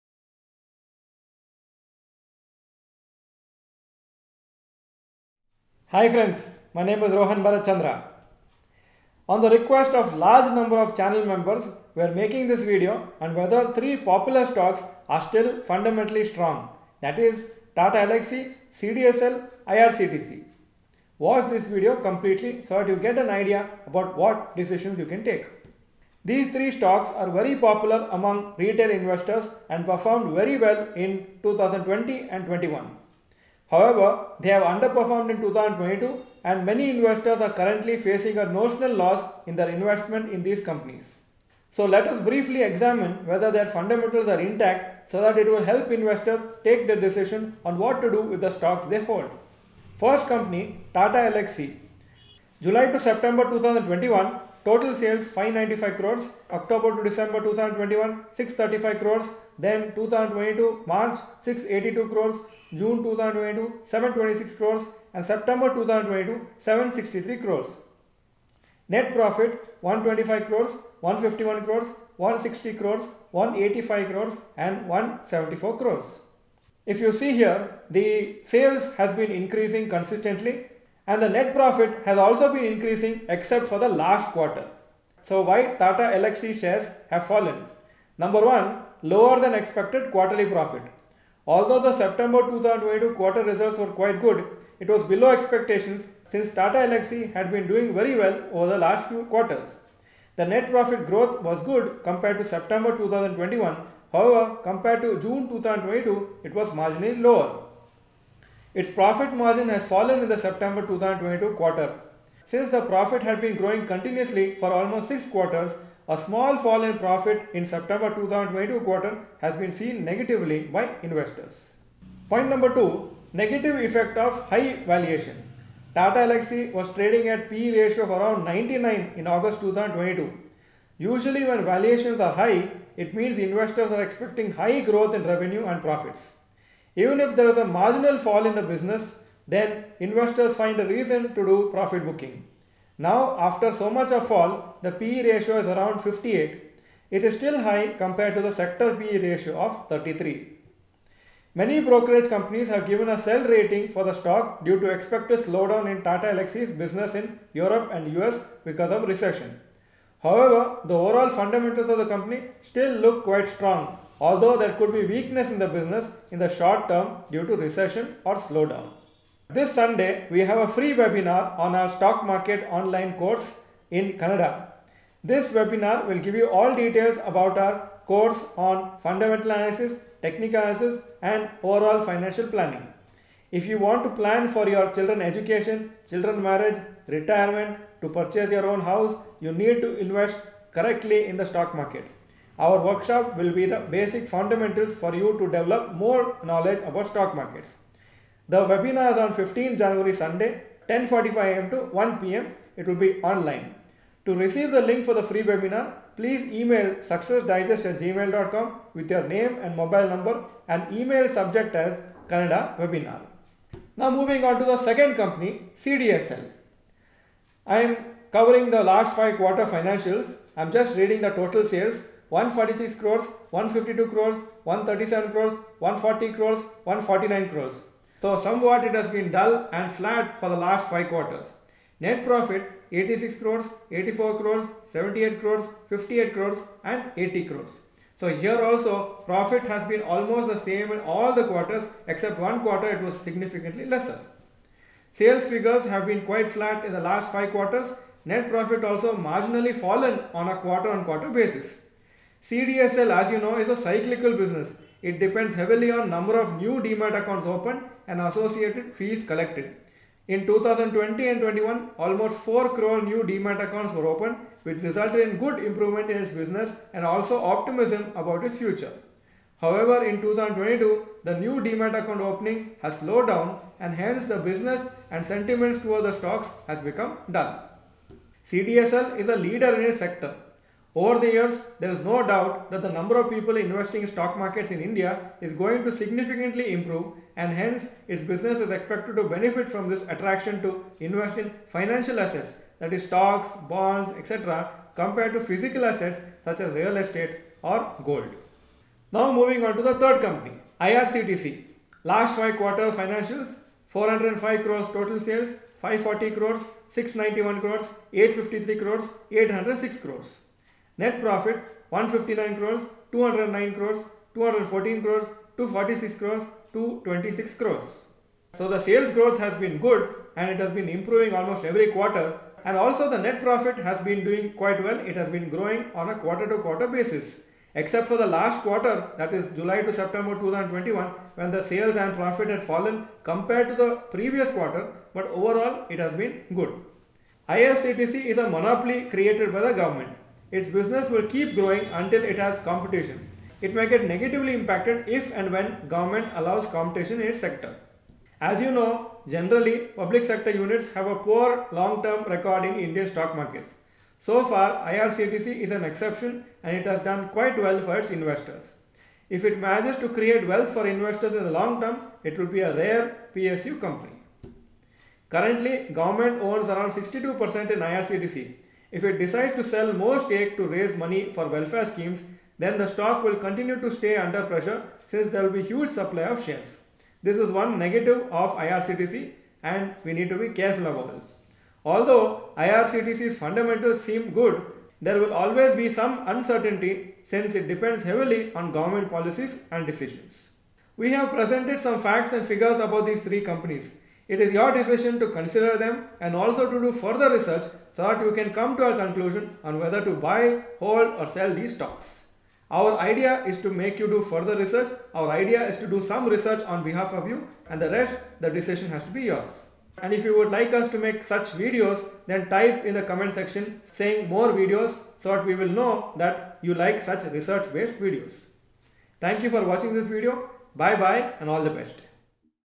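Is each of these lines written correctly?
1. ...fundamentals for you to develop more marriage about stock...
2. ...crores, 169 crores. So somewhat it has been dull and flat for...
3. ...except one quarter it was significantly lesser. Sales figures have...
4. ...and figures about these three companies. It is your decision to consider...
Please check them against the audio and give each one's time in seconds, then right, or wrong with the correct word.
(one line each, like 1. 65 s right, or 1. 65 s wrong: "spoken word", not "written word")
1. 194 s wrong: "knowledge", not "marriage"
2. 226 s wrong: "149", not "169"
3. 242 s right
4. 392 s right.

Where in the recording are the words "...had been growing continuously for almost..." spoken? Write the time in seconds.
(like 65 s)
113 s.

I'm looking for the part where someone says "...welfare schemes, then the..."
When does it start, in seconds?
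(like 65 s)
371 s.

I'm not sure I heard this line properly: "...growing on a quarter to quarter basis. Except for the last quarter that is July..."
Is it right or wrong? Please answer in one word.
right.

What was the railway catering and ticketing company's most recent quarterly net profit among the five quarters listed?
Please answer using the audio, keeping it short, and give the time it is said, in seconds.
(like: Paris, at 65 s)
226 crores, at 316 s.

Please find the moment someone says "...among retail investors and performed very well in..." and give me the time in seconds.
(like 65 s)
28 s.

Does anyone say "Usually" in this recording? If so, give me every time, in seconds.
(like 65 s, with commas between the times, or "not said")
130 s.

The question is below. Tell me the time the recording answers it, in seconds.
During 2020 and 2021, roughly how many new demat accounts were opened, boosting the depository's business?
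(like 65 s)
262 s.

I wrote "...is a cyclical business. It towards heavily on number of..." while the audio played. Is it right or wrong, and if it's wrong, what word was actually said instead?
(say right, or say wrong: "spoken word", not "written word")
wrong: "depends", not "towards".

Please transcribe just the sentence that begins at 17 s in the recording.
That is Tata Elxsi, CDSL, IRCTC.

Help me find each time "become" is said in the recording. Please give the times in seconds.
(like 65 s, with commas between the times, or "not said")
276 s.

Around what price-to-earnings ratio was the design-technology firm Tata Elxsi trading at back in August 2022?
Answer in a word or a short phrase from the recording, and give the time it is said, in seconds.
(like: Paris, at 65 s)
99, at 128 s.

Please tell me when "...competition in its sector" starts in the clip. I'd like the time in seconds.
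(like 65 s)
346 s.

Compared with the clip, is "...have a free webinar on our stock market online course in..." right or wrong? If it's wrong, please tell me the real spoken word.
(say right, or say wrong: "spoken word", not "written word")
right.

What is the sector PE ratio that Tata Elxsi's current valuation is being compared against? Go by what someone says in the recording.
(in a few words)
33.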